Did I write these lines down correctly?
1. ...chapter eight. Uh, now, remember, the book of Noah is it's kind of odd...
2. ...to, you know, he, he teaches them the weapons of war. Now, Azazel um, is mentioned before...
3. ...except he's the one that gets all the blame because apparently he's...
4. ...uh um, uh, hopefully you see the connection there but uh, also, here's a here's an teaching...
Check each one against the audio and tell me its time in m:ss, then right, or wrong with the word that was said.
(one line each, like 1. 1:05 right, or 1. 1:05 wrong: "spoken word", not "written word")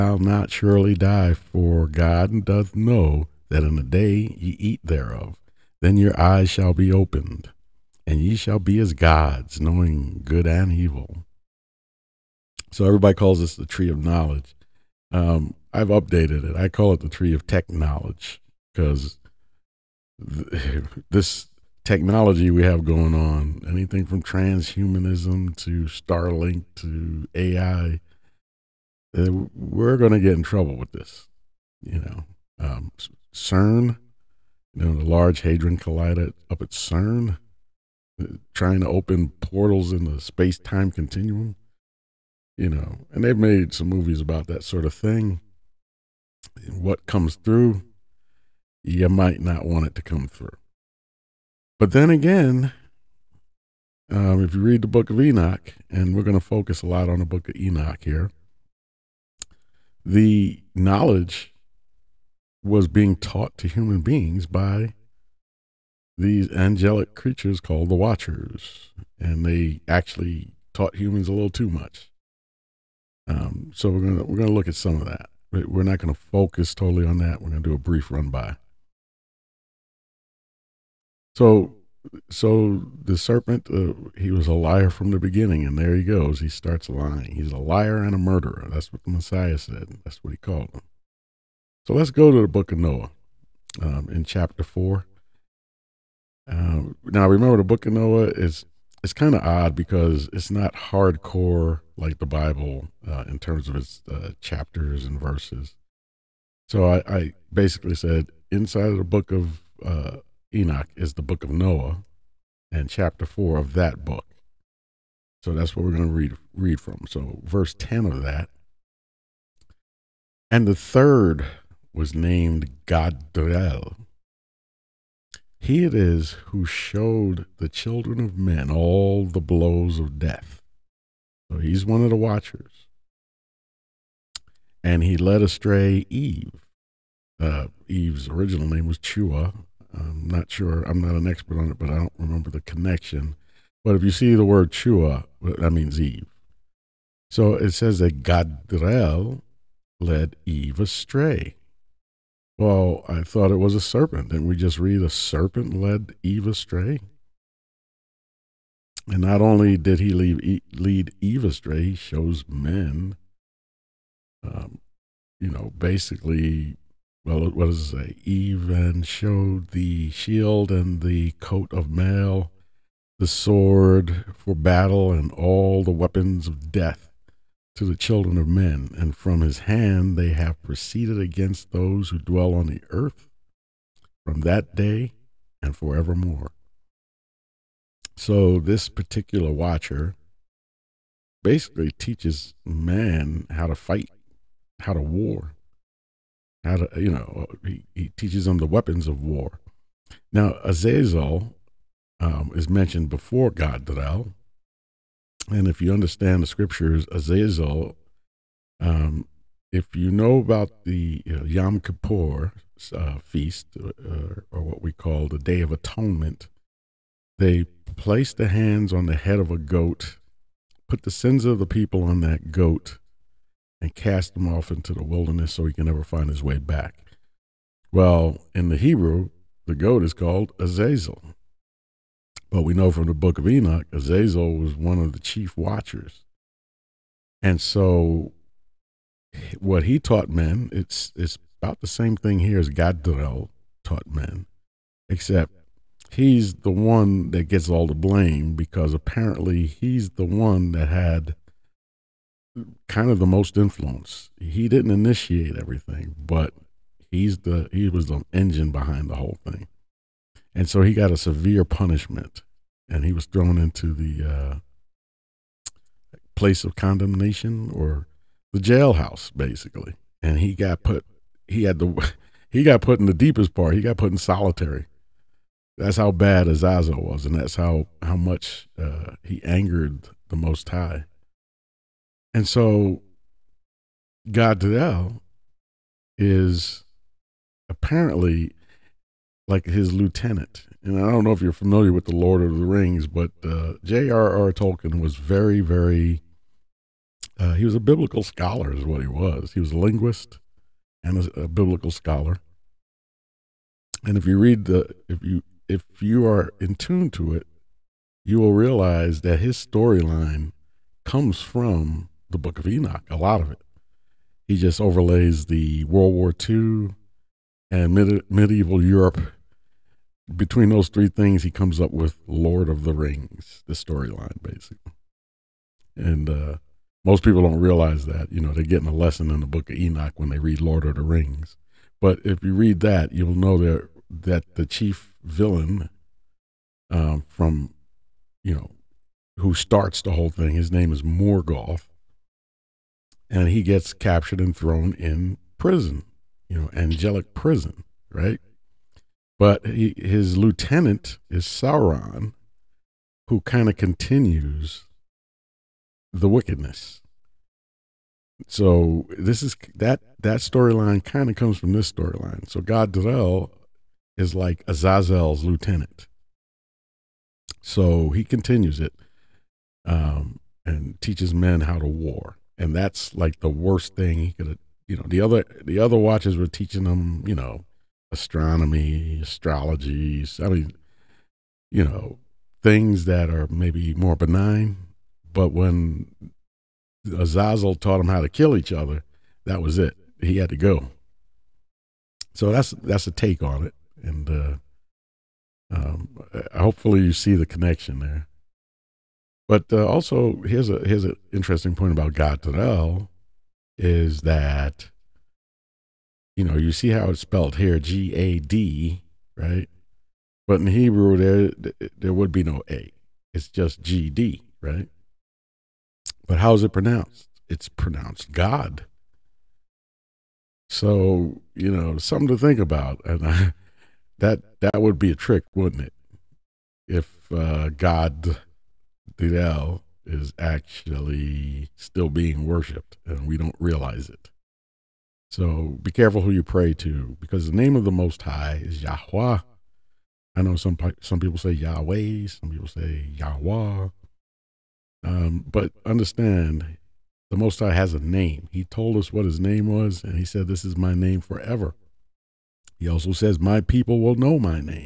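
1. 1:34 wrong: "four", not "eight"
2. 3:16 right
3. 4:05 right
4. 6:34 wrong: "interesting", not "teaching".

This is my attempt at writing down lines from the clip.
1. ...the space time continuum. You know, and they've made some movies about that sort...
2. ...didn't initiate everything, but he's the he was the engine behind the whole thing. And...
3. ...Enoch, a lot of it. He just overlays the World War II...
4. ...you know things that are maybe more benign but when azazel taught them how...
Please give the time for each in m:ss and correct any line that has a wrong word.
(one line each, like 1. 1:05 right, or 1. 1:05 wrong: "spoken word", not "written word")
1. 0:40 right
2. 4:14 right
3. 5:12 right
4. 6:21 right.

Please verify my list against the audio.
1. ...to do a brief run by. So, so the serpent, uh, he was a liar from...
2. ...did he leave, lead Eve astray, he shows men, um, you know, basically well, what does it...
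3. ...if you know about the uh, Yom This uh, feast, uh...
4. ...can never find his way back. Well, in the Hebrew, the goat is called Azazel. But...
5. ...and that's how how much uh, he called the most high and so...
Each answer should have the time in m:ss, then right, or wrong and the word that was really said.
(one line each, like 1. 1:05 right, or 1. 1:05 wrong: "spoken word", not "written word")
1. 1:17 right
2. 2:39 right
3. 3:29 wrong: "Kippur", not "This"
4. 3:45 right
5. 4:37 wrong: "angered", not "called".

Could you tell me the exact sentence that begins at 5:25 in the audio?
And uh, most people don't realize that.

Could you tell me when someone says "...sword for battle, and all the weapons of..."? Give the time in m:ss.
2:53.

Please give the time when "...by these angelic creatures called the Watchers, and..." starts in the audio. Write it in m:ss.
1:04.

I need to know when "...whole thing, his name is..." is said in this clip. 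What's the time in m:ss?
5:40.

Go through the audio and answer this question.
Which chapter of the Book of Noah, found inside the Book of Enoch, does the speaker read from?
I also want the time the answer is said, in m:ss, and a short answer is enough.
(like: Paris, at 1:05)
4, at 1:52.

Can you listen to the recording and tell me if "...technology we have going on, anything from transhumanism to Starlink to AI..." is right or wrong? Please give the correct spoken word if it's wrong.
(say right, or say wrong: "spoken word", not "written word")
right.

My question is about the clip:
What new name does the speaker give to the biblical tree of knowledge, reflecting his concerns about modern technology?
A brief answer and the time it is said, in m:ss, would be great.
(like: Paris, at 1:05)
Tree of tech knowledge, at 0:17.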